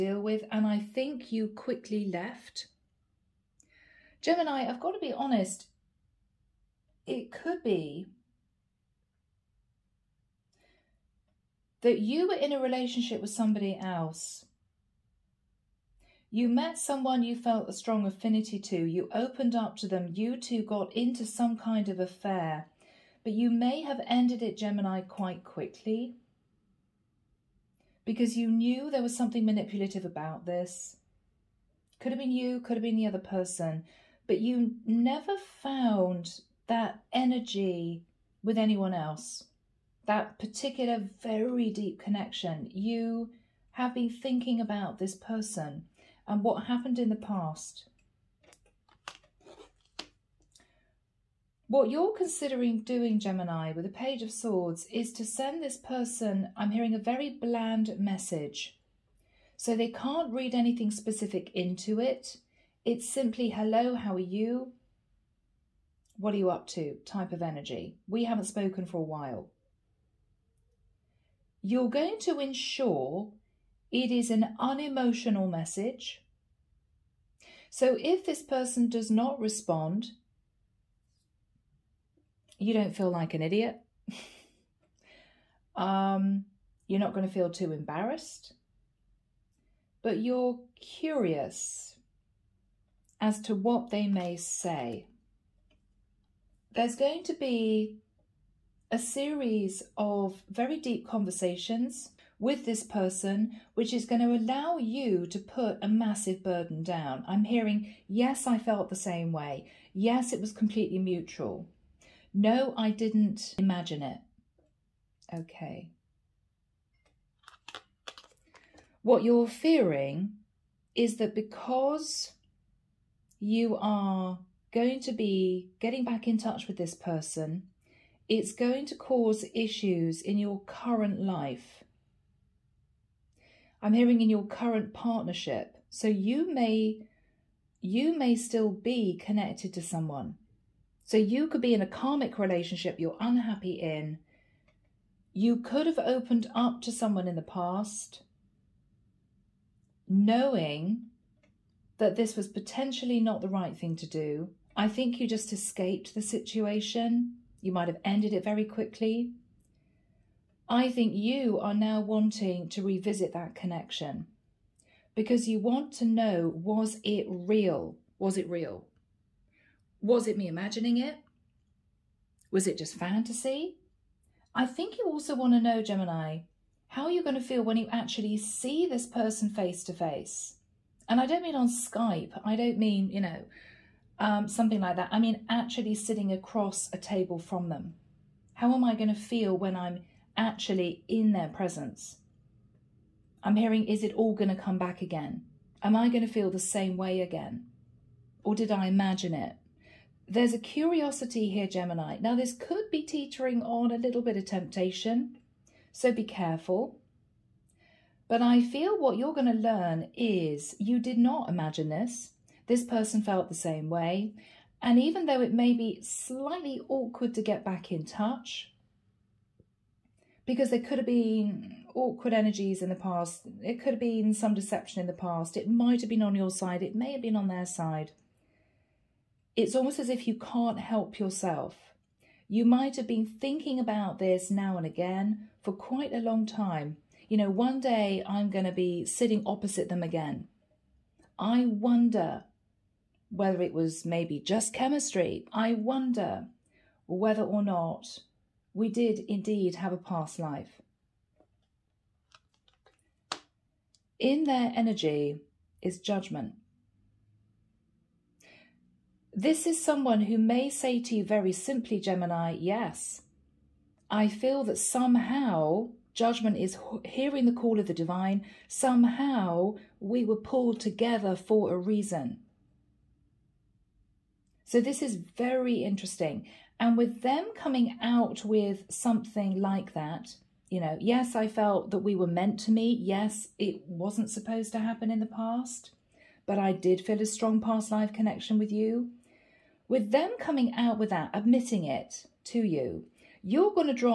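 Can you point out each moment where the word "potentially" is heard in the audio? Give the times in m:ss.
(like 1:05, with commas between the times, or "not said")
2:32.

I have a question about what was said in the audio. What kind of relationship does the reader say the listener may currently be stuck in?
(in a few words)
karmic relationship.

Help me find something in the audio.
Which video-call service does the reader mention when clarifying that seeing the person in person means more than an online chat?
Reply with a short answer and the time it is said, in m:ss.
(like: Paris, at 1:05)
Skype, at 3:01.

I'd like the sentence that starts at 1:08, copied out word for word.
We haven't spoken for a while.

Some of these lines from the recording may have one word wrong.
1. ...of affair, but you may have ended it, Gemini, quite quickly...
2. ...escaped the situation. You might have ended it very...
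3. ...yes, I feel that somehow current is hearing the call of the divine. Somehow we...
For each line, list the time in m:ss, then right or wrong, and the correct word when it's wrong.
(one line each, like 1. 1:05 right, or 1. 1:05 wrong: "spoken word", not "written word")
1. 0:21 right
2. 2:35 right
3. 4:22 wrong: "judgment", not "current".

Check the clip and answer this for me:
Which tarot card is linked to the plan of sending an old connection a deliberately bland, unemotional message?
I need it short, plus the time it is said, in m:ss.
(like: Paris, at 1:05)
Page of Swords, at 0:53.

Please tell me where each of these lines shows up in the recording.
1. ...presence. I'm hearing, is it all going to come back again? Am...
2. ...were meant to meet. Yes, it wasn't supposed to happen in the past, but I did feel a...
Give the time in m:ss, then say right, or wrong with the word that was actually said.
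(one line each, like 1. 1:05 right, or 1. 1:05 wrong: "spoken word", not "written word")
1. 3:11 right
2. 4:42 right.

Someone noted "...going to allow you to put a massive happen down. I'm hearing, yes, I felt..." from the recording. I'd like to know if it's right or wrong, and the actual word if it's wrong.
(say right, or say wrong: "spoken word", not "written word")
wrong: "burden", not "happen".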